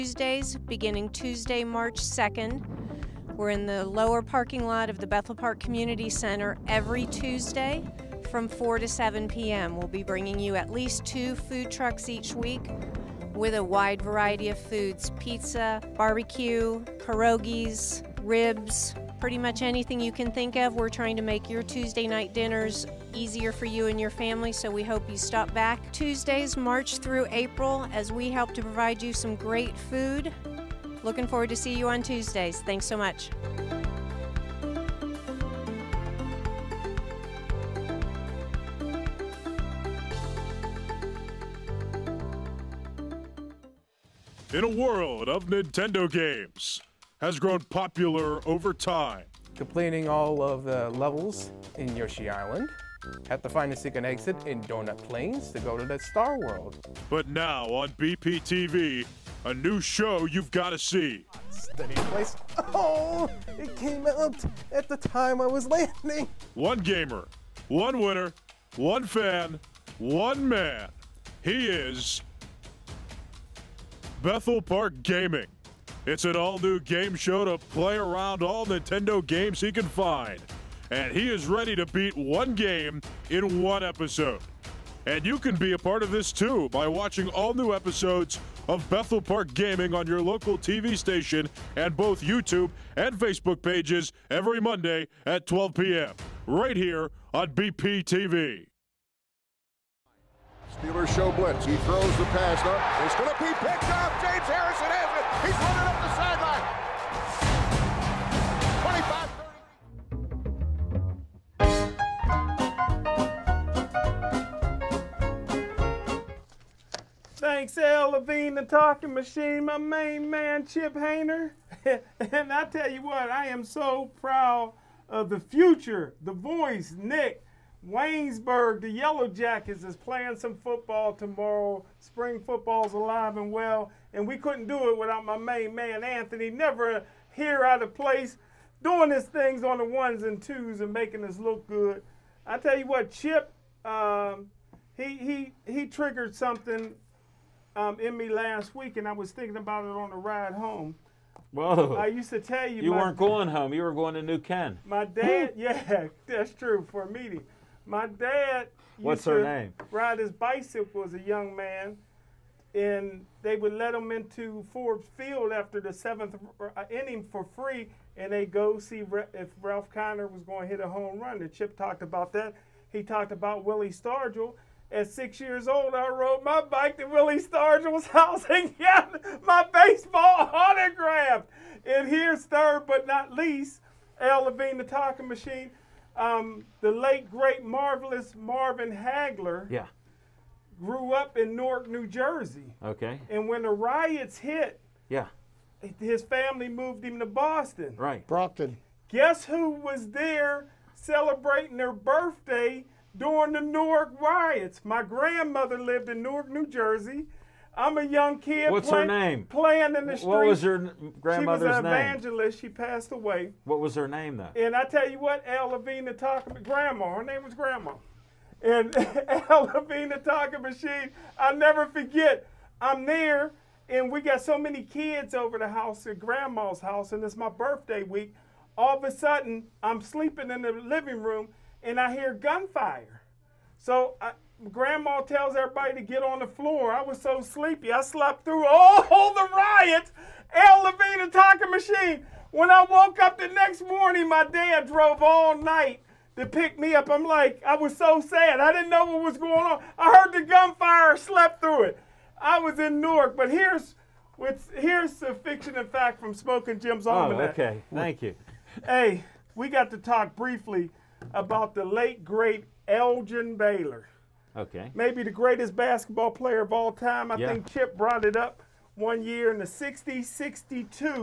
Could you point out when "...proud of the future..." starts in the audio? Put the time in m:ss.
2:04.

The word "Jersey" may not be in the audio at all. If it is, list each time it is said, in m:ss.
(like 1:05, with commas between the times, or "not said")
3:12, 3:26.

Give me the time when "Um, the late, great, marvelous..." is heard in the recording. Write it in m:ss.
3:06.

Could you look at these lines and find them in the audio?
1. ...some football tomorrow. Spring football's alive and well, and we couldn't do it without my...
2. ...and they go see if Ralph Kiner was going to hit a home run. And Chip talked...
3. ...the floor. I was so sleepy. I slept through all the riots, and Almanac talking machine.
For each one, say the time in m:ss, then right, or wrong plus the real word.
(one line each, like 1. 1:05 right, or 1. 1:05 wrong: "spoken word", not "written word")
1. 2:10 right
2. 2:48 right
3. 3:56 wrong: "Levine", not "Almanac".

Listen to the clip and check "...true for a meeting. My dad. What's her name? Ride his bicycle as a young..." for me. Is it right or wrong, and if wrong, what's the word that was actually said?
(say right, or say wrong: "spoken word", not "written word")
right.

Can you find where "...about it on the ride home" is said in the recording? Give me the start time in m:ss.
2:29.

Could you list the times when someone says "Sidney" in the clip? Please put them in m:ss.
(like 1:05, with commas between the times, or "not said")
not said.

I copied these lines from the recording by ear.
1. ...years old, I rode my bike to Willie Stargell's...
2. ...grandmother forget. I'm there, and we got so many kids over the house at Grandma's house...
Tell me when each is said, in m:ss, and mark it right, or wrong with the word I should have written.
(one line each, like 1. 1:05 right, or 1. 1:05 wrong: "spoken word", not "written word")
1. 2:55 right
2. 3:41 wrong: "never", not "grandmother".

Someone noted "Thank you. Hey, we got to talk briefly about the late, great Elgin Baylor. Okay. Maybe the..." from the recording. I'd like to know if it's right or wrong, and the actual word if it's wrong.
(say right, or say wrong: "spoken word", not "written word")
right.